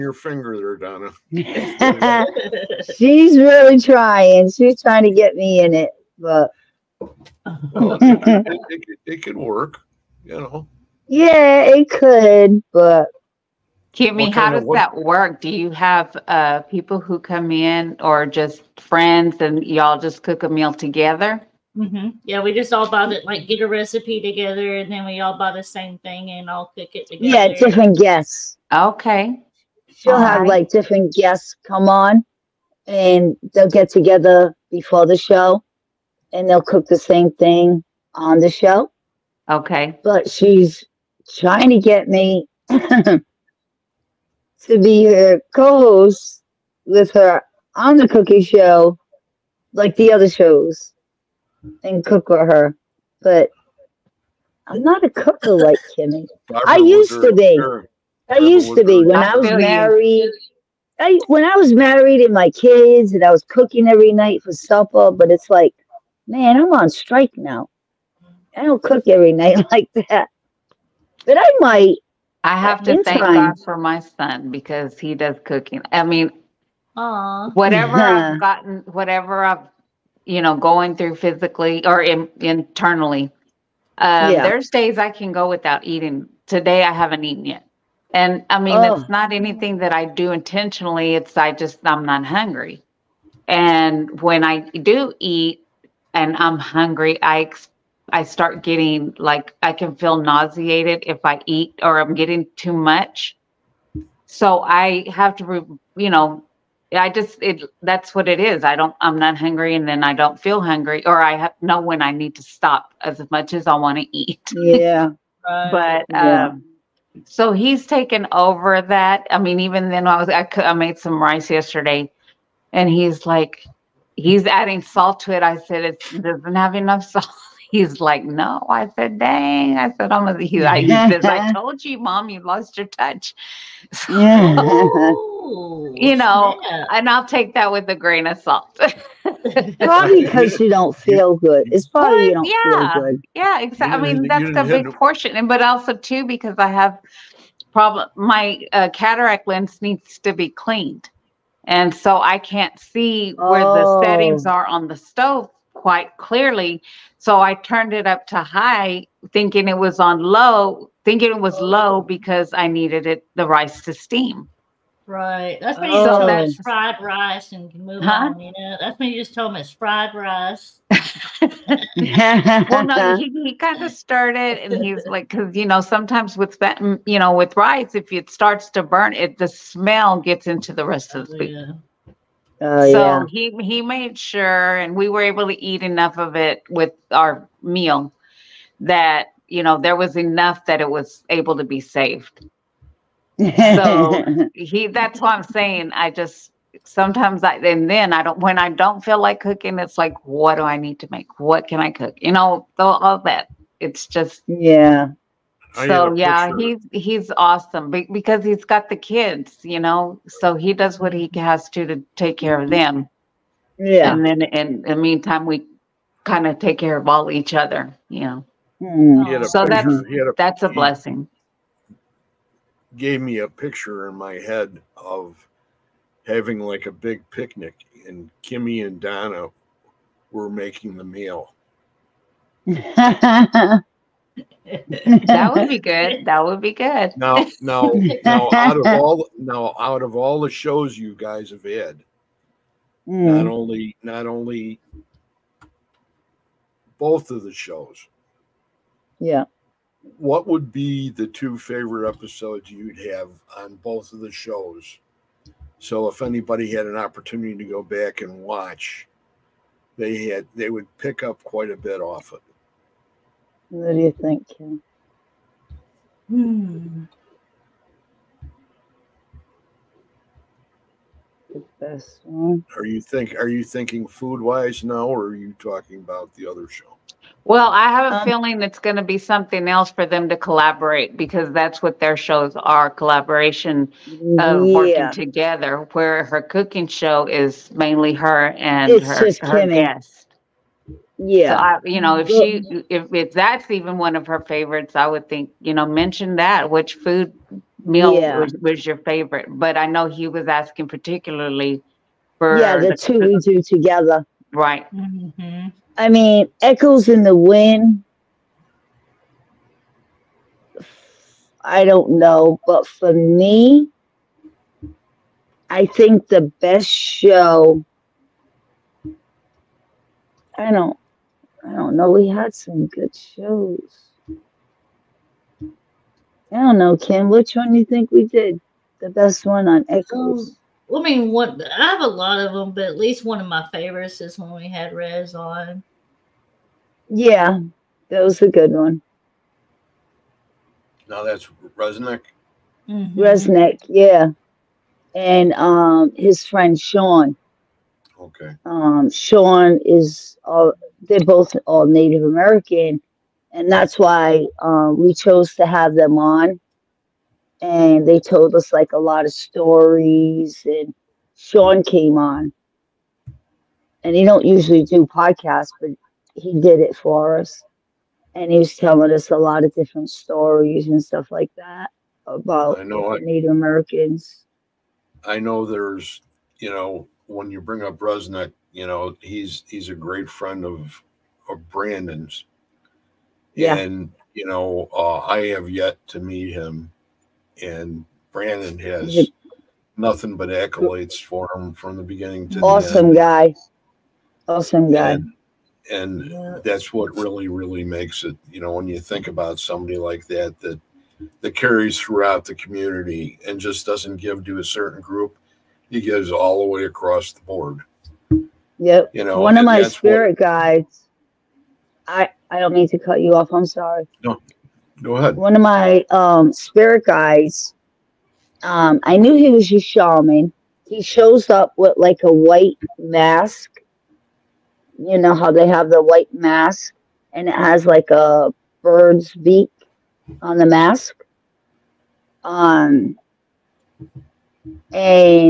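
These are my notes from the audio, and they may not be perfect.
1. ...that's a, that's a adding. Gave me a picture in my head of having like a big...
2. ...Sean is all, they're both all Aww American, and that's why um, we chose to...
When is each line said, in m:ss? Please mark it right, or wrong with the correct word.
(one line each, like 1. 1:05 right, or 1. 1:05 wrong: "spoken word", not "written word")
1. 3:39 wrong: "blessing", not "adding"
2. 5:49 wrong: "Native", not "Aww".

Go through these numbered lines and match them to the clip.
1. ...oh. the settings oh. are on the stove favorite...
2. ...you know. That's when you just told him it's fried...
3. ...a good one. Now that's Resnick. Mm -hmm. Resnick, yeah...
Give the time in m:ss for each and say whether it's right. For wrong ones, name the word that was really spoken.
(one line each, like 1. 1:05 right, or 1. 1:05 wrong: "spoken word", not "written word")
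1. 2:33 wrong: "quite", not "favorite"
2. 2:48 right
3. 5:38 right.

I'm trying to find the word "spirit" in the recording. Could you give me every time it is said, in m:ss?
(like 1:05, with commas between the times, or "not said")
6:49, 6:56.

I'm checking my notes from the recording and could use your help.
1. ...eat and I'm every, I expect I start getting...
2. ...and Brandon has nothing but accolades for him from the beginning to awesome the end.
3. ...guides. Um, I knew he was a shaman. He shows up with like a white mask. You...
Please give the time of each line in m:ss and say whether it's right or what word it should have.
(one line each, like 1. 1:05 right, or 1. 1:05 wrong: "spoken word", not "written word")
1. 1:35 wrong: "hungry", not "every"
2. 6:27 right
3. 6:57 right.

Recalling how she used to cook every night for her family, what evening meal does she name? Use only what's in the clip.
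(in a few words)
supper.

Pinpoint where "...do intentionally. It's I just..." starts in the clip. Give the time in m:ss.
1:30.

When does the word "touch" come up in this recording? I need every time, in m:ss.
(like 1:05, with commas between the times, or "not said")
2:12.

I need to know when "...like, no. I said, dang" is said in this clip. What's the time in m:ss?
2:07.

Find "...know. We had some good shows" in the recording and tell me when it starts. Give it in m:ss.
5:21.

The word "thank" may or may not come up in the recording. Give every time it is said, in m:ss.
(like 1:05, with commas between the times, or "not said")
1:13.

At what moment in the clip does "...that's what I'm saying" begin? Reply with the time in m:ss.
3:14.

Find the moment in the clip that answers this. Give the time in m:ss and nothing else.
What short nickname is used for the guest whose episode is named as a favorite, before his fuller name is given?
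5:34.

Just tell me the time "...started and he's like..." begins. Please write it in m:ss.
2:53.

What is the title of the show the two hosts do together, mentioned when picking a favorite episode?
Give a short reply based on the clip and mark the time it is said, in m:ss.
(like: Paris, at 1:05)
Echoes in the Wind, at 5:06.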